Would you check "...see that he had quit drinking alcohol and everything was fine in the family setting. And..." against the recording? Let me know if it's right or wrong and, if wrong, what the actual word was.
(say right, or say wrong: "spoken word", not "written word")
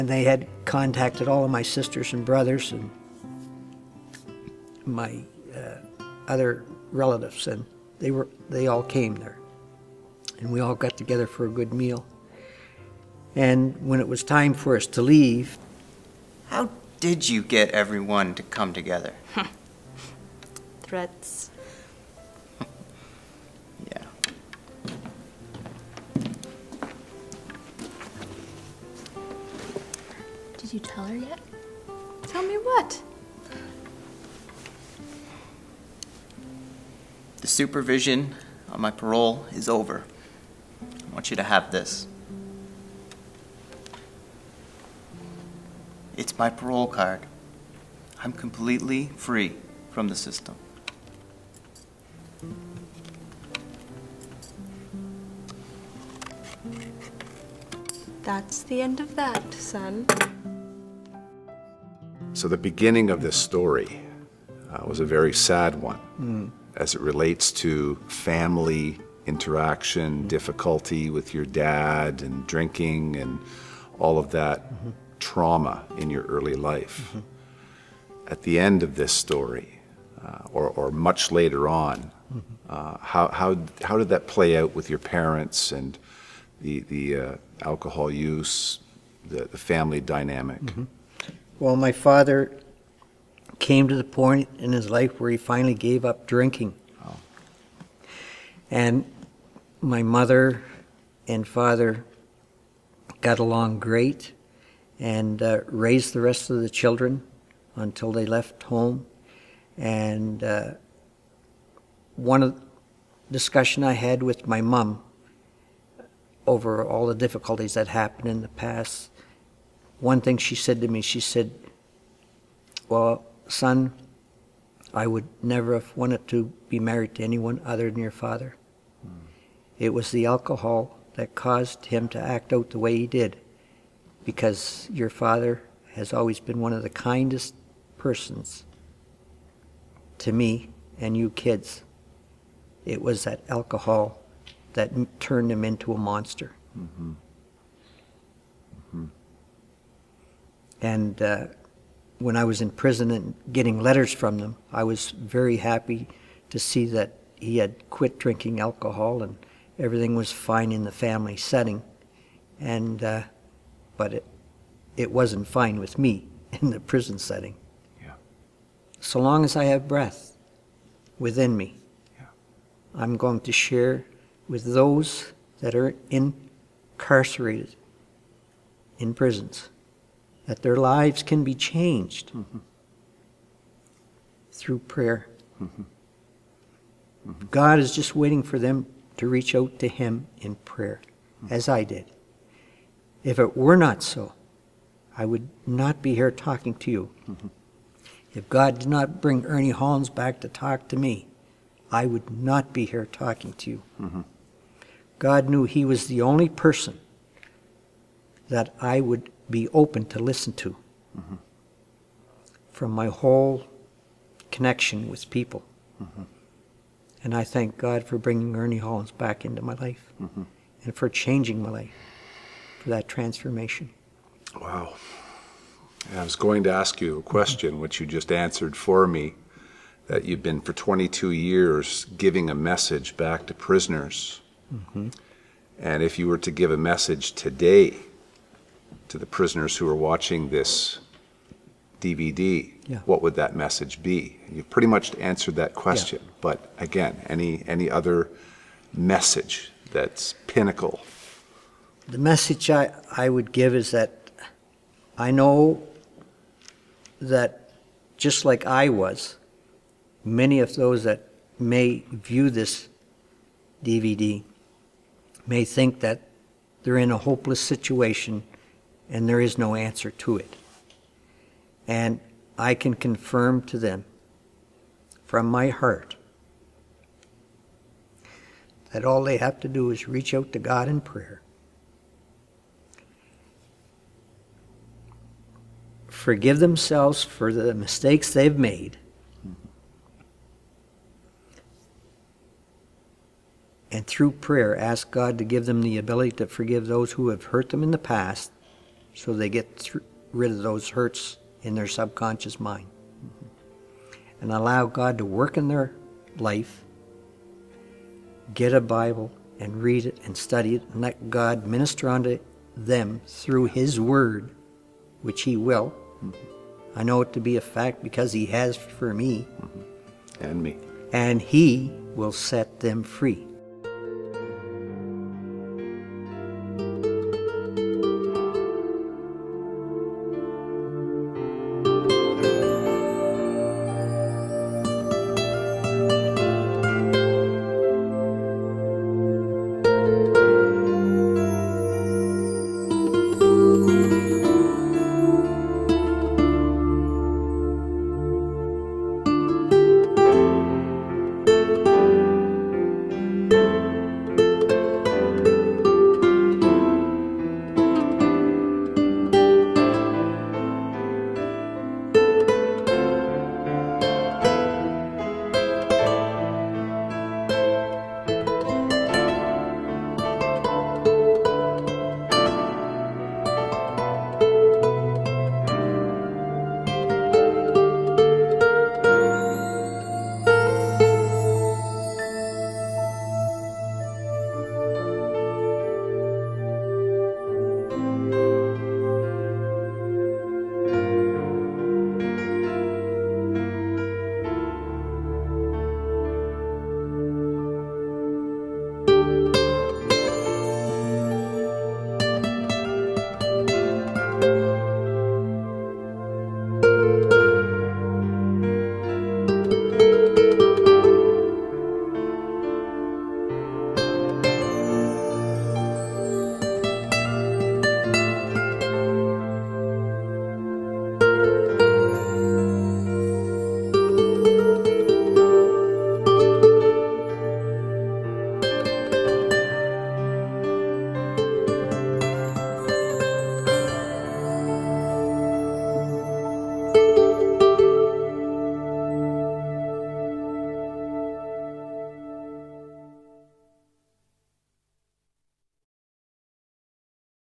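right.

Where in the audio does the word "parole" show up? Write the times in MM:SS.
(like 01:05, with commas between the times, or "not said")
00:38, 00:46.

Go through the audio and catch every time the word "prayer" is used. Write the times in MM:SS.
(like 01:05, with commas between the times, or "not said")
03:04, 03:10, 04:41, 04:54.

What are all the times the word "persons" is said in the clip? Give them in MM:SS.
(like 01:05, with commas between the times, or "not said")
02:17, 03:26.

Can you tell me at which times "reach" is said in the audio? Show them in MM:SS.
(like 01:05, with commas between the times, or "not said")
03:09, 04:40.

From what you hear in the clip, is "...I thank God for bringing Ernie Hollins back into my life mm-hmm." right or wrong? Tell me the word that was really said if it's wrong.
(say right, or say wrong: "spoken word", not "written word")
right.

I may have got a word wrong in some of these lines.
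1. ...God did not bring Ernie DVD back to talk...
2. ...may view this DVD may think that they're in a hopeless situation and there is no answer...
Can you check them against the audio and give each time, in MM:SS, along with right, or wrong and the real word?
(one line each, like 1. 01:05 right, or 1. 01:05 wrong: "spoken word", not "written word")
1. 03:18 wrong: "Hollins", not "DVD"
2. 04:21 right.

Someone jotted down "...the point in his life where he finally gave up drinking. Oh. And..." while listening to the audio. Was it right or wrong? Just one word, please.
right.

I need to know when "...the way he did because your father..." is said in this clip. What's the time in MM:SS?
02:12.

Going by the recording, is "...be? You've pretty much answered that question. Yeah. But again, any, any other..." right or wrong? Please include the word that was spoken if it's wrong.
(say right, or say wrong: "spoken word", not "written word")
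right.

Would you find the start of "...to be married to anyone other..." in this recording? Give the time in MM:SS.
02:06.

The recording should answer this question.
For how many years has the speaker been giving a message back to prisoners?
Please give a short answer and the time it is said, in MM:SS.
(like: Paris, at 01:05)
22, at 03:50.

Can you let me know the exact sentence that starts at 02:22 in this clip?
It was that alcohol that turned him into a monster.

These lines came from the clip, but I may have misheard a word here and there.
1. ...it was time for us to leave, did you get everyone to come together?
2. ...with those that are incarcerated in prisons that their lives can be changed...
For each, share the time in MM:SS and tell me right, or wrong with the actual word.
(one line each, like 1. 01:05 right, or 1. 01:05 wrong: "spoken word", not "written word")
1. 00:14 right
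2. 02:54 right.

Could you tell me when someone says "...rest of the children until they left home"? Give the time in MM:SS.
01:46.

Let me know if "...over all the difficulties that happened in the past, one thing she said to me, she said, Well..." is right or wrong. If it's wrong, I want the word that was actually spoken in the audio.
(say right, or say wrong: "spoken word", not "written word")
right.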